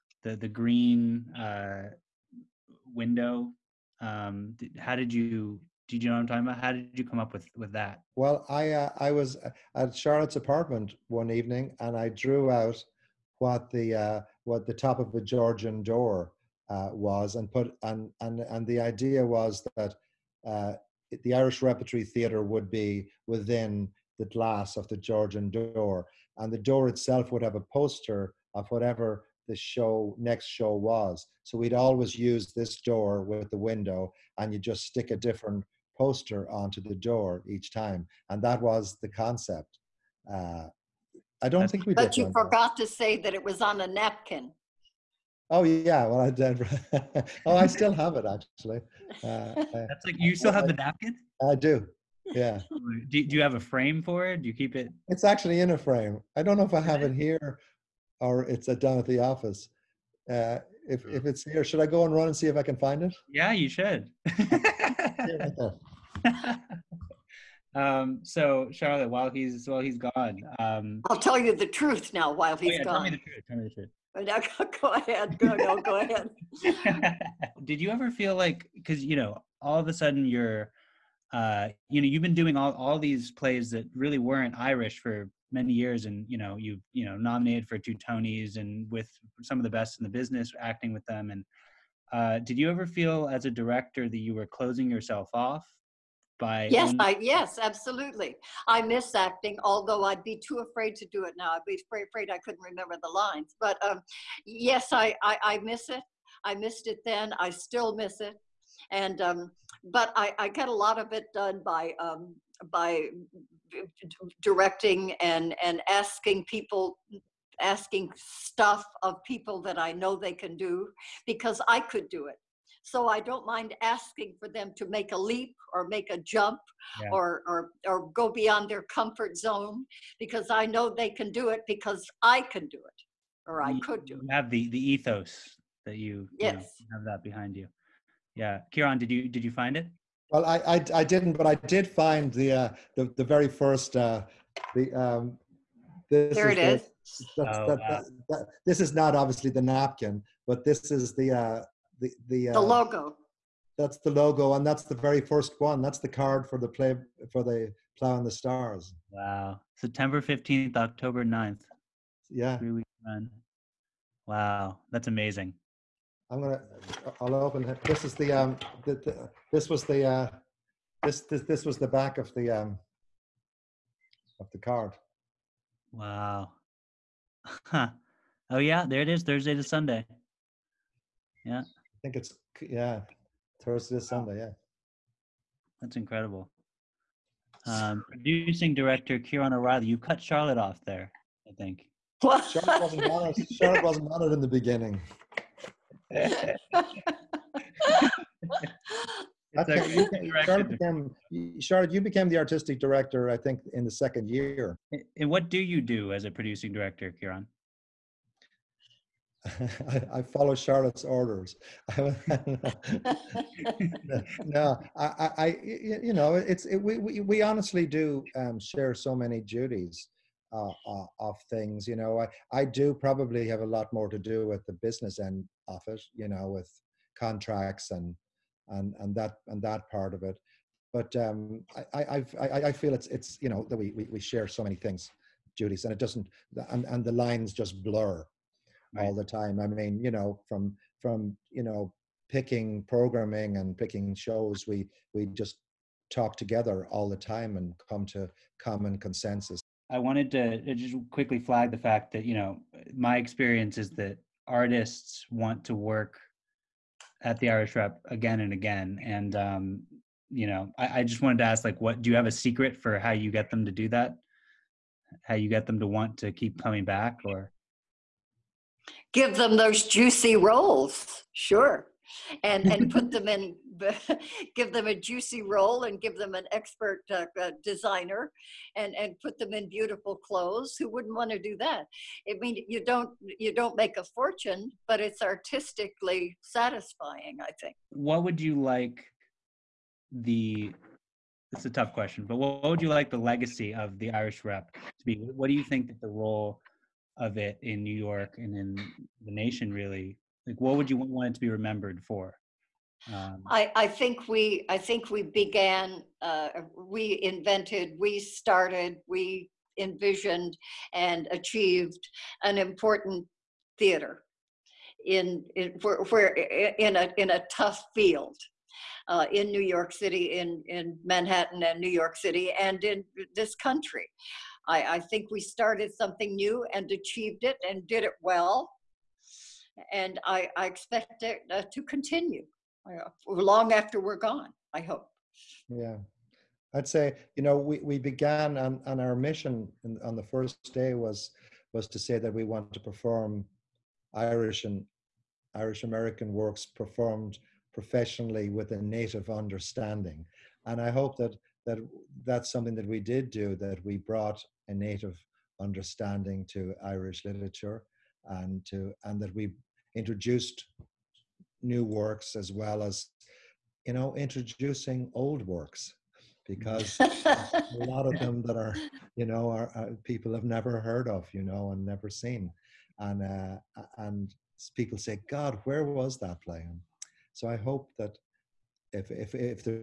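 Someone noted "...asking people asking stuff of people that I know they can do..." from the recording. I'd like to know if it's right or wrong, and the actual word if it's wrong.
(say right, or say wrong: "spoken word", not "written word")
right.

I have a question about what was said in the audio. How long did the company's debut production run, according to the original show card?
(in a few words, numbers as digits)
3 weeks.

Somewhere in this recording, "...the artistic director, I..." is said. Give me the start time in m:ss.
3:22.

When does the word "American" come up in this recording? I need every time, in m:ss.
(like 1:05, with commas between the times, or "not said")
5:45.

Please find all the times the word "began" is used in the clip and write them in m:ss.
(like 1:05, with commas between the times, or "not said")
5:05, 5:37.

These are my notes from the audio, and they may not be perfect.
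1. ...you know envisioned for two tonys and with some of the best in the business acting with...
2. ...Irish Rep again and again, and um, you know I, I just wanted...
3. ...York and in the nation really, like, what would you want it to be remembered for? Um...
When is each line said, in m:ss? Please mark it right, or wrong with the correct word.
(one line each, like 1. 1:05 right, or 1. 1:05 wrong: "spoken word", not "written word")
1. 1:26 wrong: "nominated", not "envisioned"
2. 4:17 right
3. 4:57 right.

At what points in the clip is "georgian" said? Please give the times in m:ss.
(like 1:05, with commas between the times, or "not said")
0:15, 0:24.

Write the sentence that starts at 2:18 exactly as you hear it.
Yeah, Ciaran, did you did you find it?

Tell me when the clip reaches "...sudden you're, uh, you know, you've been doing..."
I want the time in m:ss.
1:19.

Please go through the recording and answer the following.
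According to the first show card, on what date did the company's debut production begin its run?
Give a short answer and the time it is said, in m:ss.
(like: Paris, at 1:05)
September 15, at 2:39.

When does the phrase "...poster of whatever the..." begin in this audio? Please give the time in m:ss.
0:27.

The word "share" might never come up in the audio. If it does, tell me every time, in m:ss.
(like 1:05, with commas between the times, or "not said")
3:38, 3:54.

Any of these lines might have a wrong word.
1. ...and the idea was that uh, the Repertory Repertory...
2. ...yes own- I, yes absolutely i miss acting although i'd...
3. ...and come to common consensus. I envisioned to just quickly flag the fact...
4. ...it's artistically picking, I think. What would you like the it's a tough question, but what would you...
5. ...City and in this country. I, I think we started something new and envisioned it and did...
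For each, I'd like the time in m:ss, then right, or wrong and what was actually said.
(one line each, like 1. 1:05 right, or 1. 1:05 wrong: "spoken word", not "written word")
1. 0:18 wrong: "Irish", not "Repertory"
2. 1:36 right
3. 4:07 wrong: "wanted", not "envisioned"
4. 4:44 wrong: "satisfying", not "picking"
5. 5:22 wrong: "achieved", not "envisioned".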